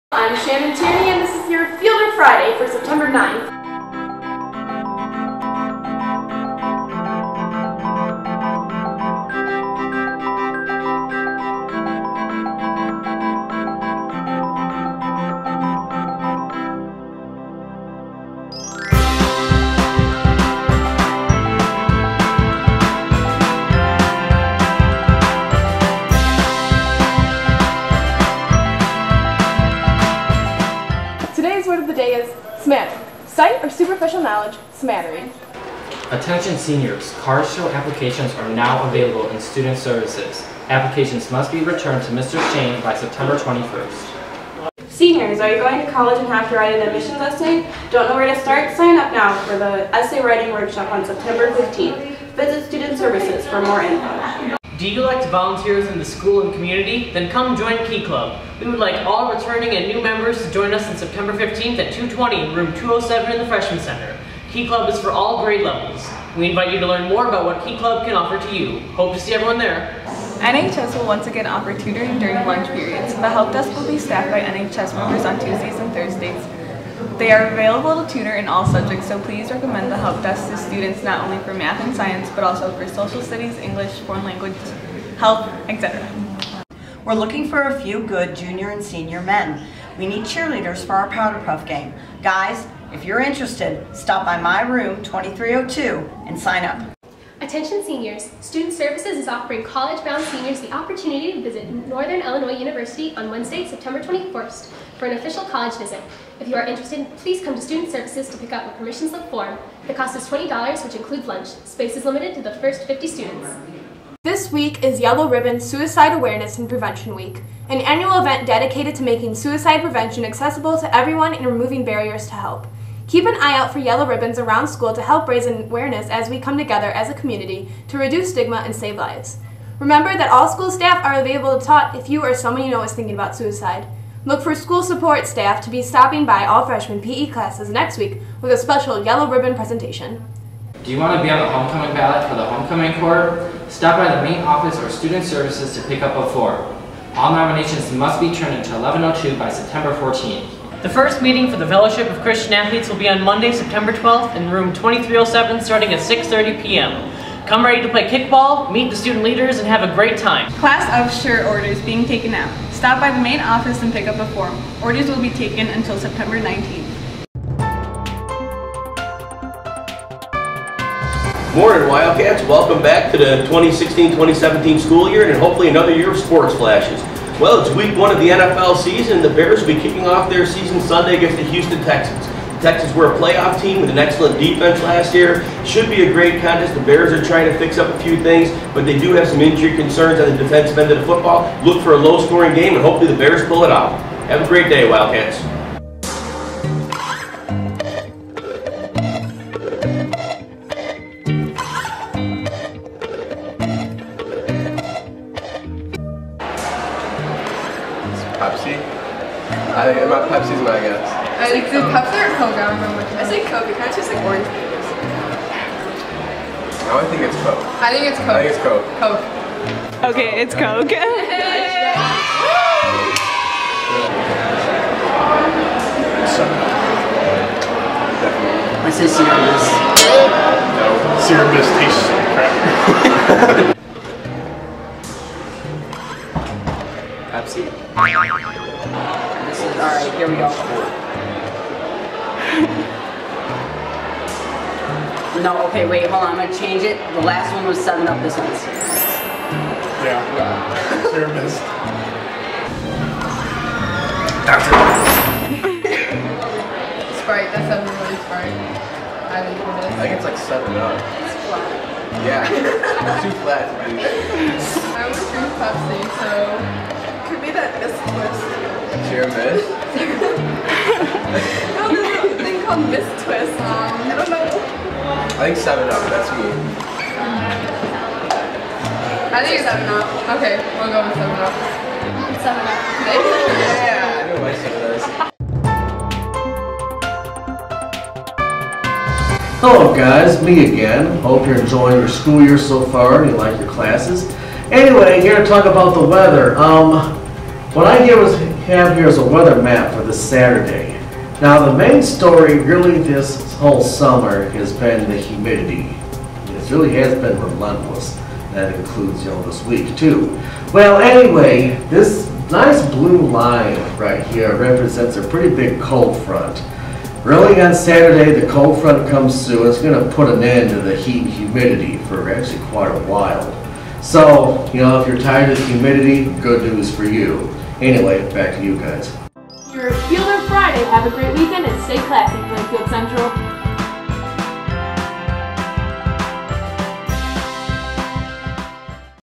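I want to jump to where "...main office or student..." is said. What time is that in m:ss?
2:24.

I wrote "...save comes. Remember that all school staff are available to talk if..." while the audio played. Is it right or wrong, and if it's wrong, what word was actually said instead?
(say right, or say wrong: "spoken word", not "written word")
wrong: "lives", not "comes".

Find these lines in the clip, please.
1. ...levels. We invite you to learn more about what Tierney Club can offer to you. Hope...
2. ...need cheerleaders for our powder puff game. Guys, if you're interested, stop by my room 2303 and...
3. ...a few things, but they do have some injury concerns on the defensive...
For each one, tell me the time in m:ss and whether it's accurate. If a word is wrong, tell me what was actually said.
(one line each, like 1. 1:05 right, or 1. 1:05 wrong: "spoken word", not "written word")
1. 1:05 wrong: "Key", not "Tierney"
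2. 1:30 wrong: "2302", not "2303"
3. 3:07 right.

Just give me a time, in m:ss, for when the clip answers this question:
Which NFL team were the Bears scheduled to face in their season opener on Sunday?
3:01.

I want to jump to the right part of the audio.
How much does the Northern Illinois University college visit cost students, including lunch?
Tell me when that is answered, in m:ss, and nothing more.
1:50.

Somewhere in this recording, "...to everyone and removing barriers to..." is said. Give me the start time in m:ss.
2:00.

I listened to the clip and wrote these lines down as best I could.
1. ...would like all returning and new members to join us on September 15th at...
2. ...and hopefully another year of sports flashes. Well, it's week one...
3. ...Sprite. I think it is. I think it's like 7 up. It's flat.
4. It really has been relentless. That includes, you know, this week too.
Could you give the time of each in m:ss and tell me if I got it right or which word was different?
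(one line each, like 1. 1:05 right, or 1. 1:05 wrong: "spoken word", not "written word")
1. 0:58 right
2. 2:55 right
3. 4:18 right
4. 5:06 right.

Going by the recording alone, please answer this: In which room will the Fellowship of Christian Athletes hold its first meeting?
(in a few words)
2307.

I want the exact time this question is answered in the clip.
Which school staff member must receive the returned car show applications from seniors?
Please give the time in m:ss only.
0:42.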